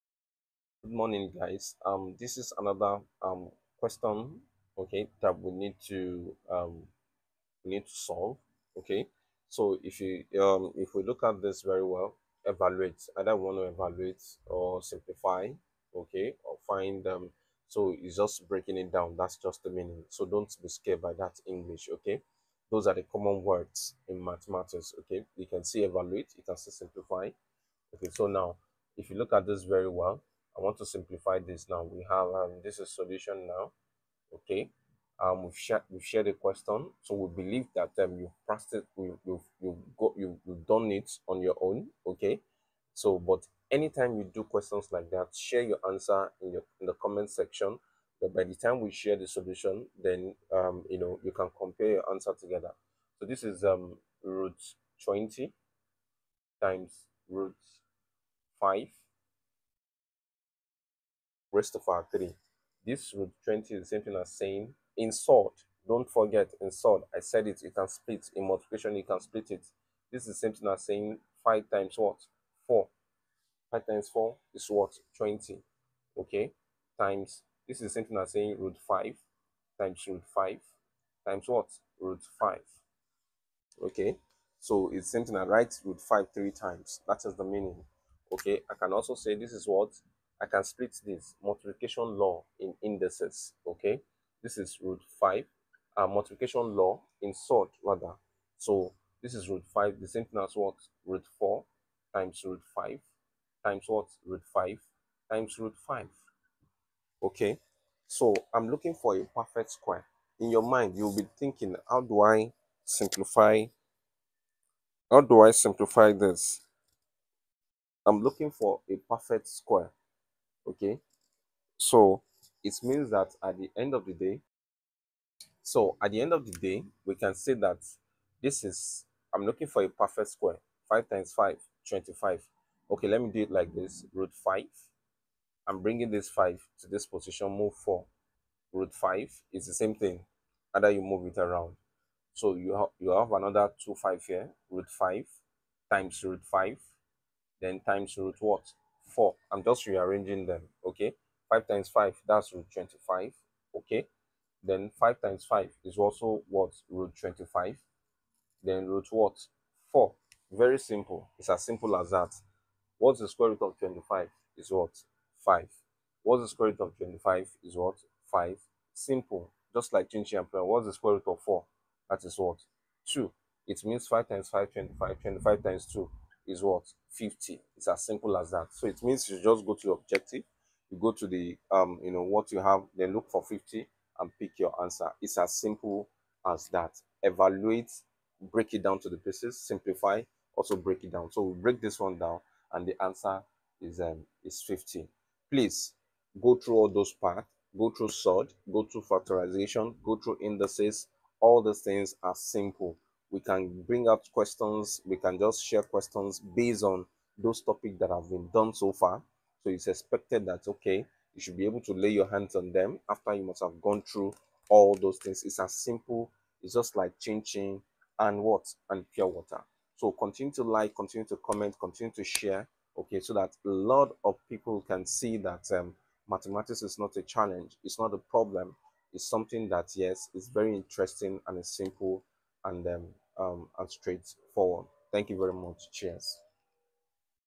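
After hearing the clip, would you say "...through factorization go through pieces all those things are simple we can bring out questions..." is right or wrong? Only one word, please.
wrong.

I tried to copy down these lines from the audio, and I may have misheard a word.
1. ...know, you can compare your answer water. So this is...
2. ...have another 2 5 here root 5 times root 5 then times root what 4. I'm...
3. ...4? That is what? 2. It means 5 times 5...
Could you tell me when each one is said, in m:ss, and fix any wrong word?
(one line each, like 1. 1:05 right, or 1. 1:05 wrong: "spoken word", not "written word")
1. 0:50 wrong: "together", not "water"
2. 2:23 right
3. 2:51 right.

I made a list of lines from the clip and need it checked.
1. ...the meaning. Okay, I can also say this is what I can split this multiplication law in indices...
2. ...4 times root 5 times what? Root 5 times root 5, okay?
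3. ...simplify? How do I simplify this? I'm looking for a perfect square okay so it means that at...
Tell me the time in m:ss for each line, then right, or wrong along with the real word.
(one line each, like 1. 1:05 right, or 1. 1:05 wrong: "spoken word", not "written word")
1. 1:27 right
2. 1:41 right
3. 1:52 right.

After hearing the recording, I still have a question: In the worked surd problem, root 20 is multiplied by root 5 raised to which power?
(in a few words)
3.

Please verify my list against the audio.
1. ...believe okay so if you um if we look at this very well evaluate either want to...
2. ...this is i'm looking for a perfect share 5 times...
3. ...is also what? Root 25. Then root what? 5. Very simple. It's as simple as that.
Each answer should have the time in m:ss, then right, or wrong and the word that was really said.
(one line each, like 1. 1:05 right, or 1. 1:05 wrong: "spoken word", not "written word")
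1. 0:07 wrong: "solve", not "believe"
2. 2:08 wrong: "square", not "share"
3. 2:35 wrong: "4", not "5".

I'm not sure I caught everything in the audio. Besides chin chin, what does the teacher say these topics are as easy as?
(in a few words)
pure water.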